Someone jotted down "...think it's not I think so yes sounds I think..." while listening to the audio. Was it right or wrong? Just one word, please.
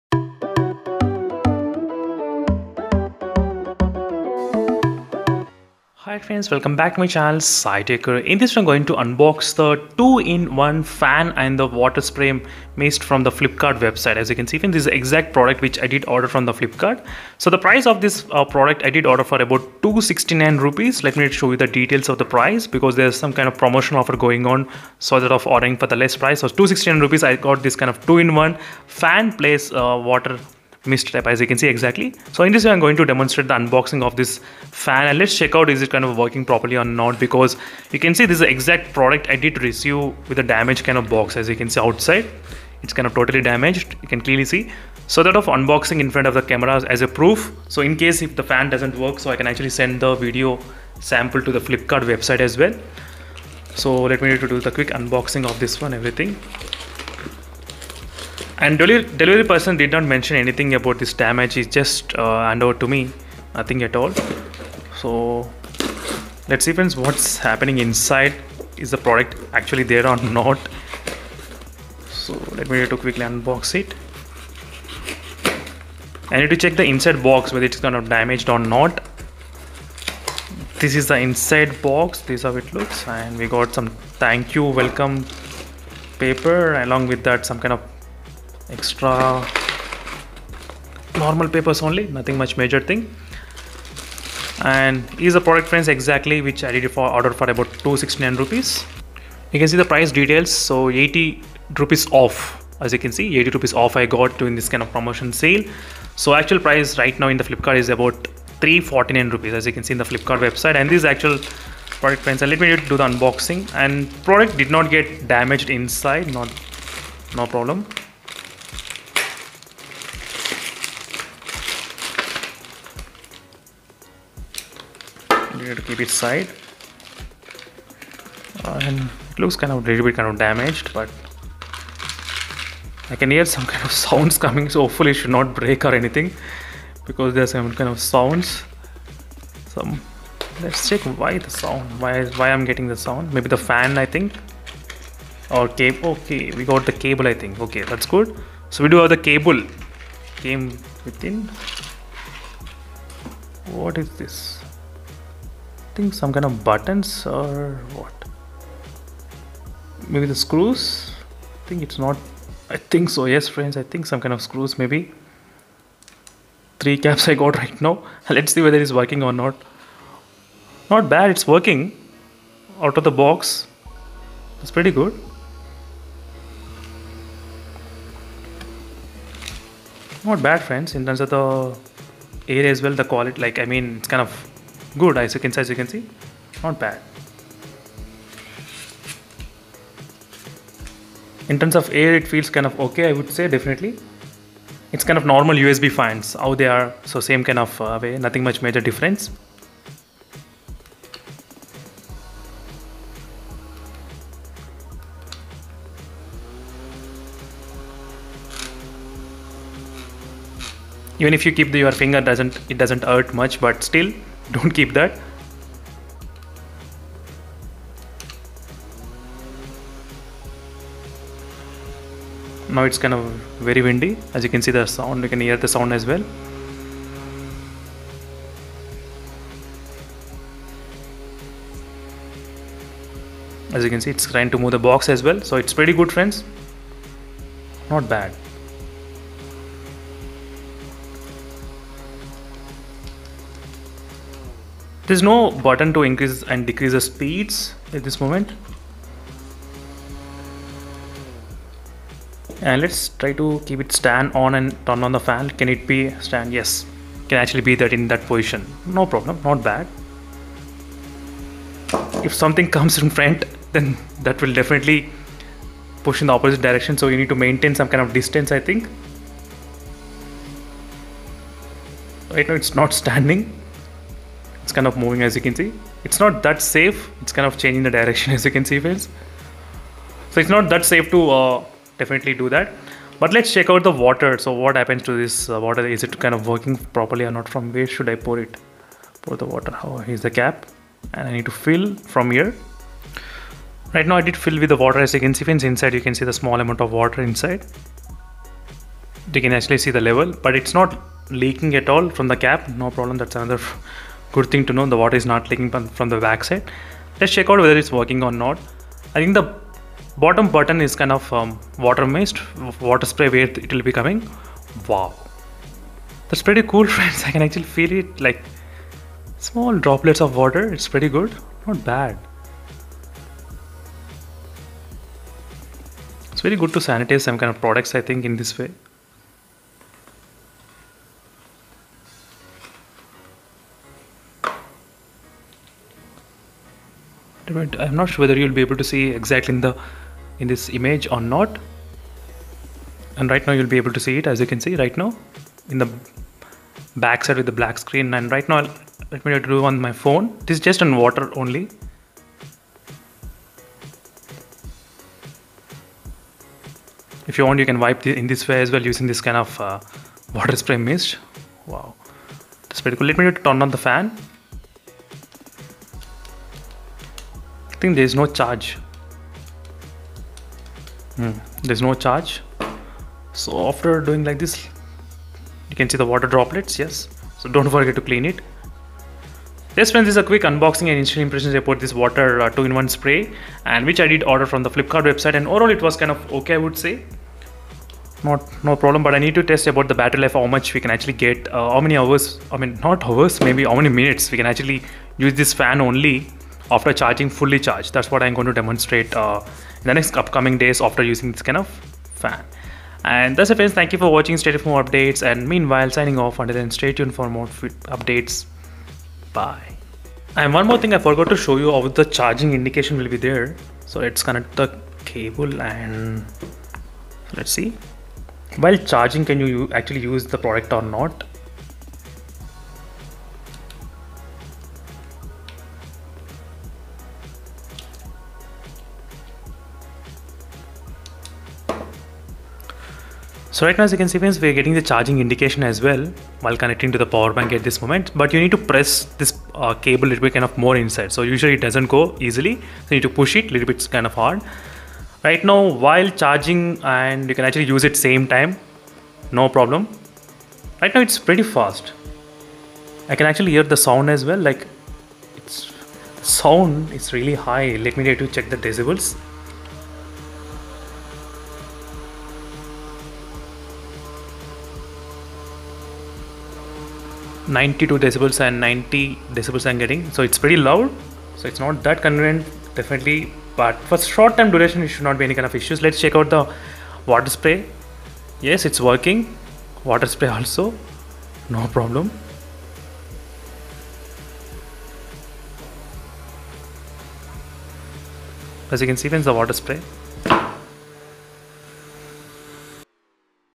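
wrong.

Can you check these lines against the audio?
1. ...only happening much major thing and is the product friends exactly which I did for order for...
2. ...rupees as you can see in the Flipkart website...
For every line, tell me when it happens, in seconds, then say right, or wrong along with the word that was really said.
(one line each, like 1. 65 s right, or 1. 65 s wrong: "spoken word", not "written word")
1. 91 s wrong: "nothing", not "happening"
2. 109 s right.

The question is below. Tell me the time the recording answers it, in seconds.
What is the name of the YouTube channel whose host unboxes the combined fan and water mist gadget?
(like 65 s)
7 s.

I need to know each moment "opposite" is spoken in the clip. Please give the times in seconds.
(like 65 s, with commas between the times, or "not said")
266 s.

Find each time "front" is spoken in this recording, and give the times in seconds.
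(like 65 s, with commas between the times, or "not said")
46 s, 263 s.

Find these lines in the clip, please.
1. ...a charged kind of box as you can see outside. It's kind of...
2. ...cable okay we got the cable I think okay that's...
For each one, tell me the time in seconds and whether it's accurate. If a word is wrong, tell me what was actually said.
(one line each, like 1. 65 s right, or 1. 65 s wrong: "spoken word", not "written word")
1. 40 s wrong: "damaged", not "charged"
2. 145 s right.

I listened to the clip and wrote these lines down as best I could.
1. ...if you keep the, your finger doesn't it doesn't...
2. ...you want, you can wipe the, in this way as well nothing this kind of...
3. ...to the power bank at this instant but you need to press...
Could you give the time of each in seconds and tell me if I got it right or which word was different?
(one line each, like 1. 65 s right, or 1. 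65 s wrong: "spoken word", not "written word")
1. 211 s right
2. 357 s wrong: "using", not "nothing"
3. 436 s wrong: "moment", not "instant".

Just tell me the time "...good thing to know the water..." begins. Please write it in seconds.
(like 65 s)
304 s.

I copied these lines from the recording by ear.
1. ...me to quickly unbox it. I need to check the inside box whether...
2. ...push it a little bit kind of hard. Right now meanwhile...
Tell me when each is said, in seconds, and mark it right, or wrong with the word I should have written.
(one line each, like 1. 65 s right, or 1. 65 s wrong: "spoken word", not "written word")
1. 72 s right
2. 443 s wrong: "while", not "meanwhile".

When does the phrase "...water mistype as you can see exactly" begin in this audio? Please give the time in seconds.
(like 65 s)
30 s.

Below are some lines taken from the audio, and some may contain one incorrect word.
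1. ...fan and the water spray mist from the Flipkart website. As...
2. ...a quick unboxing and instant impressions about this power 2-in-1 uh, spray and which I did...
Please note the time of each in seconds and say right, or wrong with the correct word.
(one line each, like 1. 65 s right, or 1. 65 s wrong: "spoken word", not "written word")
1. 10 s right
2. 380 s wrong: "water", not "power".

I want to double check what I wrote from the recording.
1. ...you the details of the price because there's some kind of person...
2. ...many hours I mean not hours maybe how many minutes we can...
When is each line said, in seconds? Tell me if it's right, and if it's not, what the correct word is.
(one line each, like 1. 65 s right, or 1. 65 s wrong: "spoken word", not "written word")
1. 21 s wrong: "promotion", not "person"
2. 391 s right.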